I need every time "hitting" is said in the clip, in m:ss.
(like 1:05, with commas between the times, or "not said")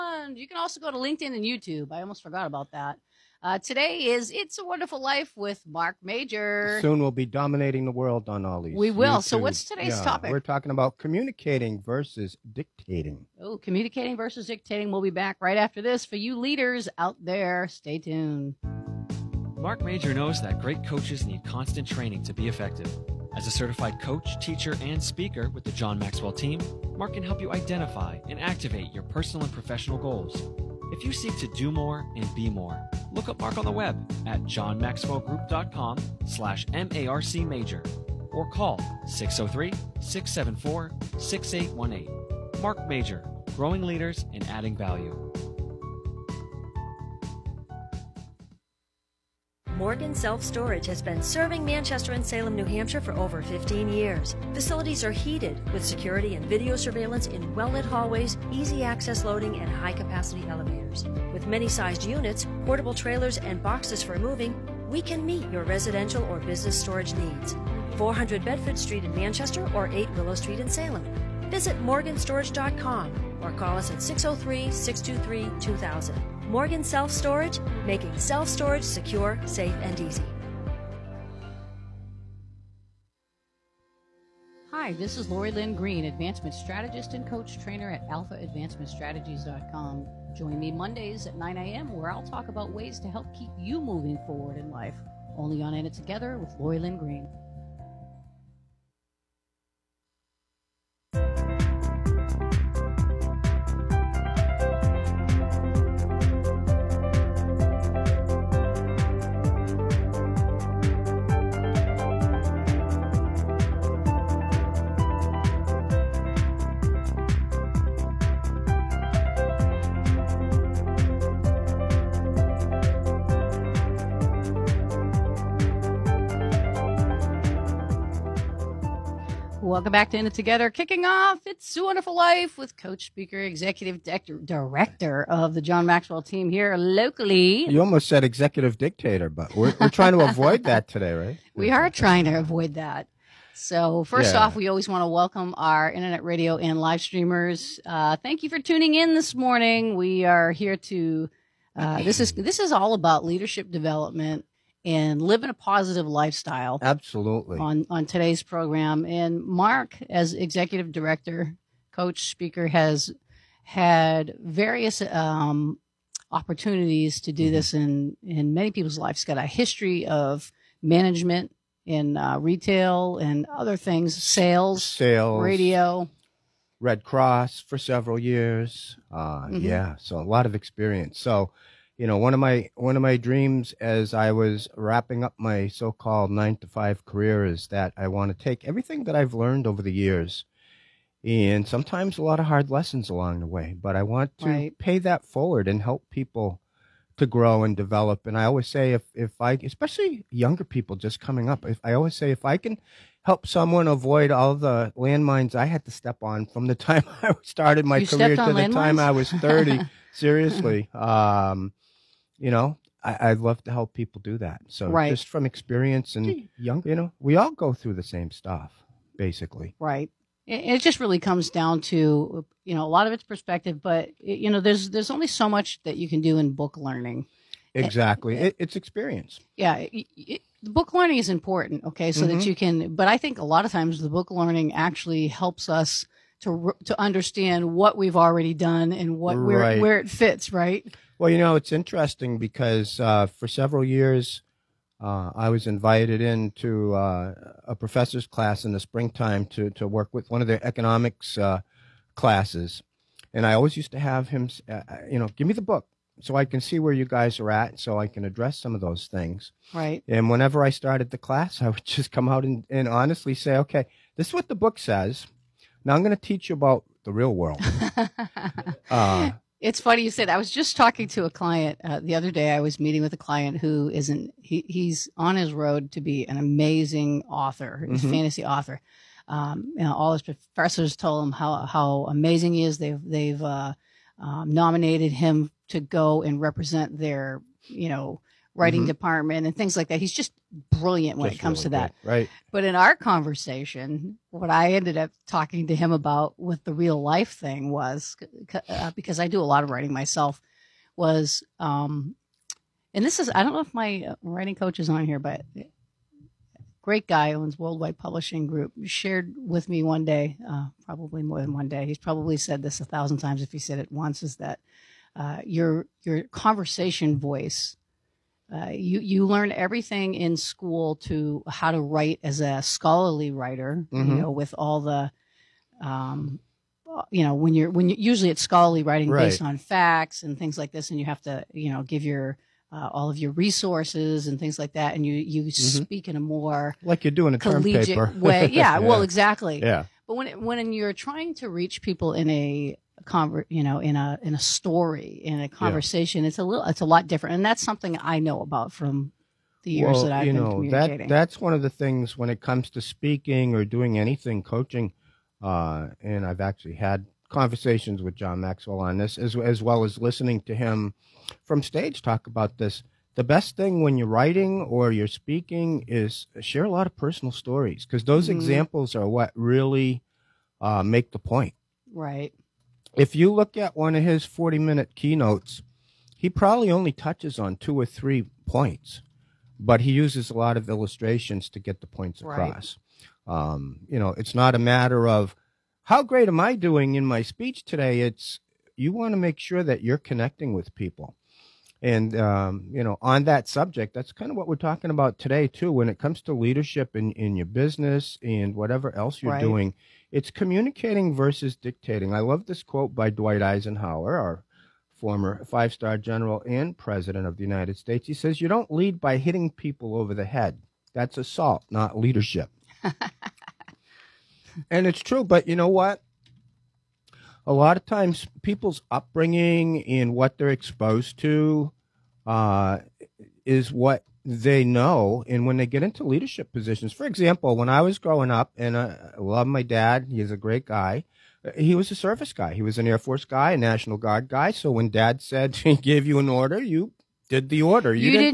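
6:49.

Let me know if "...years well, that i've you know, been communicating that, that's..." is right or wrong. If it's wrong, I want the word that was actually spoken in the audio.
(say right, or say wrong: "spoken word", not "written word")
right.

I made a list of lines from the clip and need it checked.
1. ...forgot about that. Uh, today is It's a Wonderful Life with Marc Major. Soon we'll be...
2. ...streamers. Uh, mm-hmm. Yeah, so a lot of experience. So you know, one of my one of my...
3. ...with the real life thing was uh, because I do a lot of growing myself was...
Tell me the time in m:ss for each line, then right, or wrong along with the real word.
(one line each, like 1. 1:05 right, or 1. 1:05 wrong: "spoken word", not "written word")
1. 0:02 right
2. 2:58 wrong: "years", not "streamers"
3. 4:56 wrong: "writing", not "growing".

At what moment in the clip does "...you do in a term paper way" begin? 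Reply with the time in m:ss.
5:37.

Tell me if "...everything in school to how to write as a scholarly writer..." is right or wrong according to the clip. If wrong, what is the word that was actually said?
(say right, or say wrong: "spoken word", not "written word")
right.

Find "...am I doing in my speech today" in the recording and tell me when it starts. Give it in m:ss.
6:26.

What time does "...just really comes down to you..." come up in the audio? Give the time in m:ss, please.
3:40.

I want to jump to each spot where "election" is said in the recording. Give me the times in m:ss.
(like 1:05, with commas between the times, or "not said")
not said.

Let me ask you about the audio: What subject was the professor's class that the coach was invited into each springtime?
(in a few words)
economics.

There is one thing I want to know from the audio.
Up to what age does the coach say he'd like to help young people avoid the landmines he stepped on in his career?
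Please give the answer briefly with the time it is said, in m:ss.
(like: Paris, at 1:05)
30, at 3:29.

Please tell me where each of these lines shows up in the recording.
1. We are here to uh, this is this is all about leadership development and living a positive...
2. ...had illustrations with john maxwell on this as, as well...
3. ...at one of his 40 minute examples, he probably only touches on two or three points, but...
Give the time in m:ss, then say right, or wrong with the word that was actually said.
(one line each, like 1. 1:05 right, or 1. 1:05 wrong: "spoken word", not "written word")
1. 2:29 right
2. 5:56 wrong: "conversations", not "illustrations"
3. 6:13 wrong: "keynotes", not "examples".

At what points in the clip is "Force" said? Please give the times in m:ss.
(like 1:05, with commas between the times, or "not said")
7:12.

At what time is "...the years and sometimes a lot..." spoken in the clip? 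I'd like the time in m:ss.
3:09.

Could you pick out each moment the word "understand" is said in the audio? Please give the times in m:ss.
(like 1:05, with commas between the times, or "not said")
3:57.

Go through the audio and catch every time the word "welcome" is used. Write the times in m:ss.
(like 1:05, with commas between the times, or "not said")
2:09, 2:25.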